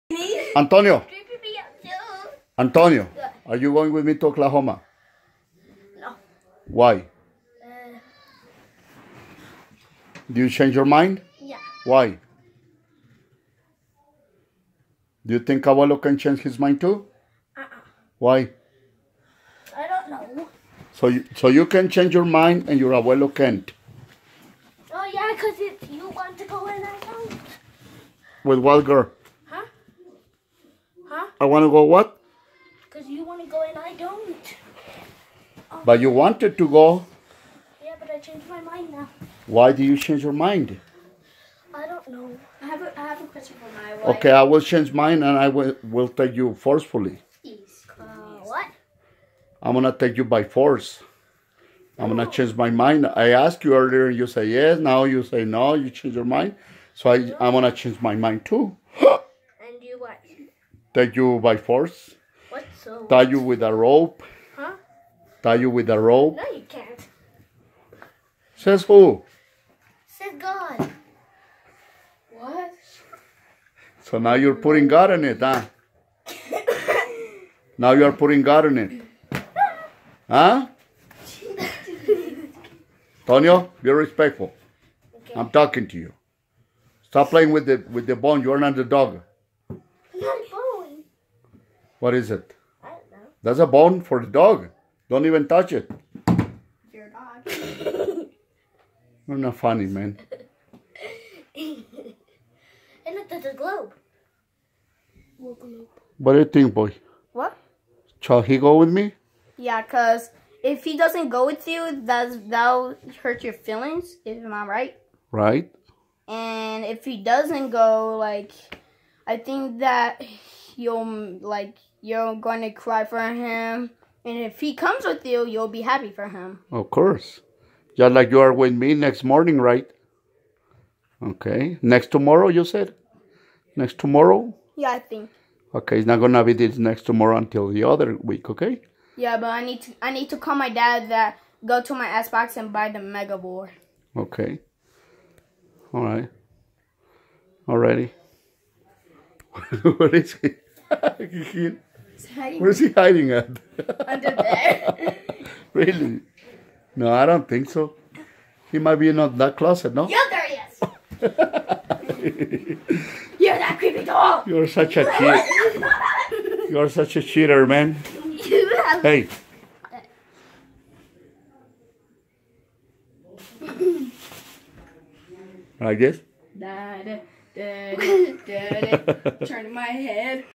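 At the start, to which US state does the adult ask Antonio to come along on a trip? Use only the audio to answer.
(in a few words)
Oklahoma.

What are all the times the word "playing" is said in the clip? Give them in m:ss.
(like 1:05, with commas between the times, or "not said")
1:27.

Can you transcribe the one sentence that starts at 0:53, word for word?
I asked you earlier, and you say yes.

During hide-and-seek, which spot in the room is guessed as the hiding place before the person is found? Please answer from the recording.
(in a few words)
closet.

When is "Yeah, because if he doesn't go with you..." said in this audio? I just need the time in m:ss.
1:49.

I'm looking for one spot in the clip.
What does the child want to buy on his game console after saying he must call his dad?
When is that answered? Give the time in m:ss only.
2:22.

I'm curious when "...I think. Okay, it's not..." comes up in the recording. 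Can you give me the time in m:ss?
2:14.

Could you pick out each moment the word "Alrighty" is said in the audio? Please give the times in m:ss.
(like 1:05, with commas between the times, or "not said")
2:27.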